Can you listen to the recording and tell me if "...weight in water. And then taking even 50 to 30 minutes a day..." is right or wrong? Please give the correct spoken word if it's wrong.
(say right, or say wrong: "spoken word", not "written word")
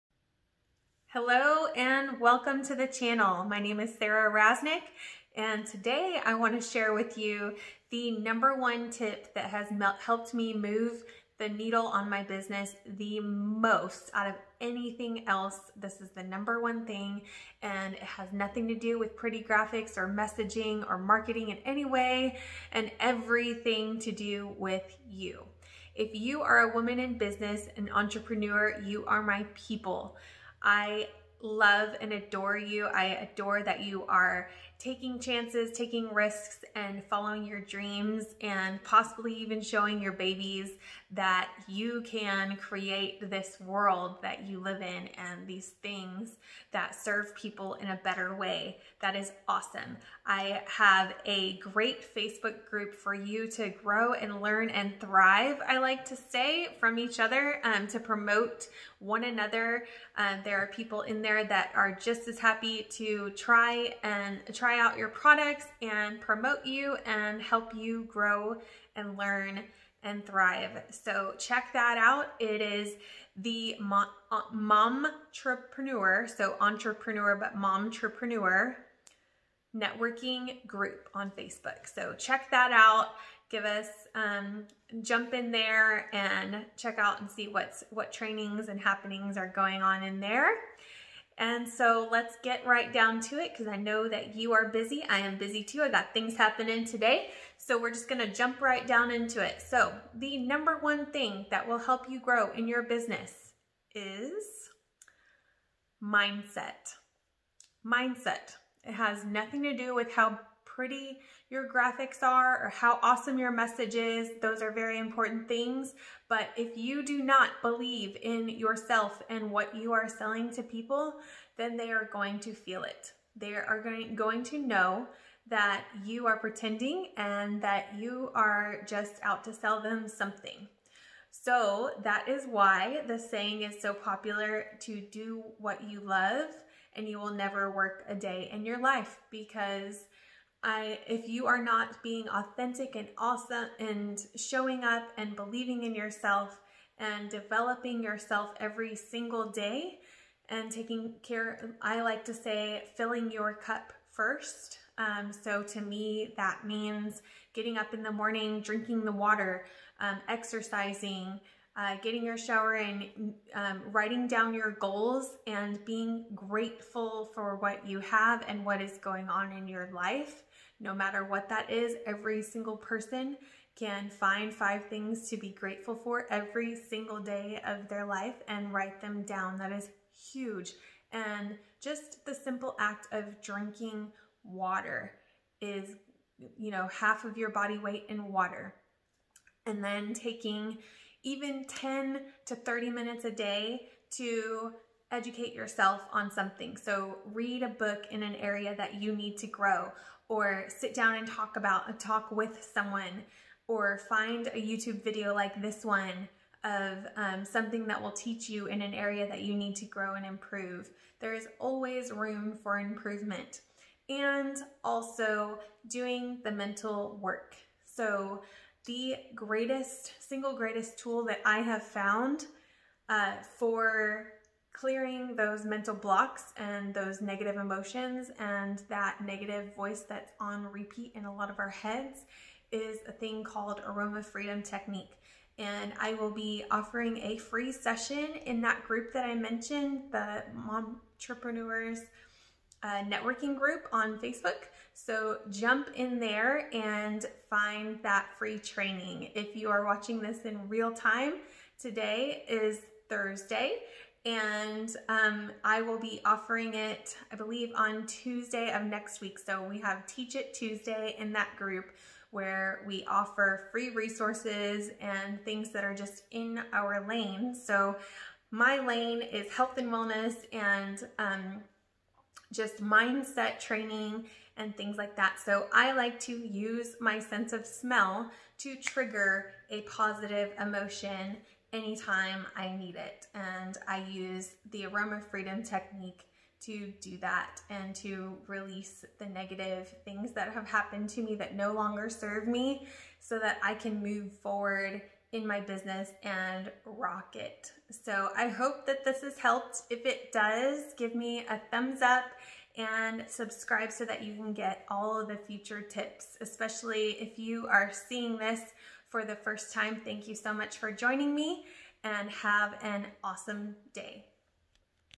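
wrong: "10", not "50".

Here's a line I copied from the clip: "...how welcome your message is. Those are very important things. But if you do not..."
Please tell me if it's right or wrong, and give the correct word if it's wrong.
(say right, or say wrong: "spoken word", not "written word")
wrong: "awesome", not "welcome".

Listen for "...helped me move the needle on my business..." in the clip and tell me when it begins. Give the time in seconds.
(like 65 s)
9 s.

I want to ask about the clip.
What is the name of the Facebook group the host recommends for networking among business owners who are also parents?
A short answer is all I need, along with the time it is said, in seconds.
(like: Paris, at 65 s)
Mom Entrepreneur Networking Group, at 77 s.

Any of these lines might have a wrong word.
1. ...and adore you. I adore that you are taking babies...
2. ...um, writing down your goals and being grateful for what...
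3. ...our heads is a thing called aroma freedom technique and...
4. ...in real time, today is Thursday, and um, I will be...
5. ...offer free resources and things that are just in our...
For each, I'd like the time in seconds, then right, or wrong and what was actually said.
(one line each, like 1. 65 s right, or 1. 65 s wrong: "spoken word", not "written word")
1. 32 s wrong: "chances", not "babies"
2. 163 s right
3. 231 s right
4. 250 s right
5. 263 s right.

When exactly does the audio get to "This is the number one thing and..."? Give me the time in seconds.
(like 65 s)
15 s.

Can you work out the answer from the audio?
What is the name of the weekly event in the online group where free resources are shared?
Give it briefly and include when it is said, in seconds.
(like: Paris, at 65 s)
Teach It Tuesday, at 260 s.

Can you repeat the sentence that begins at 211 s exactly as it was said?
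There is always room for improvement.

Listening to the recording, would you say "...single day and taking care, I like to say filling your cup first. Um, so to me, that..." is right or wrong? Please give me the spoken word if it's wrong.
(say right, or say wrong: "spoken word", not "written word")
right.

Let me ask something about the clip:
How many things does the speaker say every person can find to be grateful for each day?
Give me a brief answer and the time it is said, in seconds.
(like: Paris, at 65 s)
5, at 174 s.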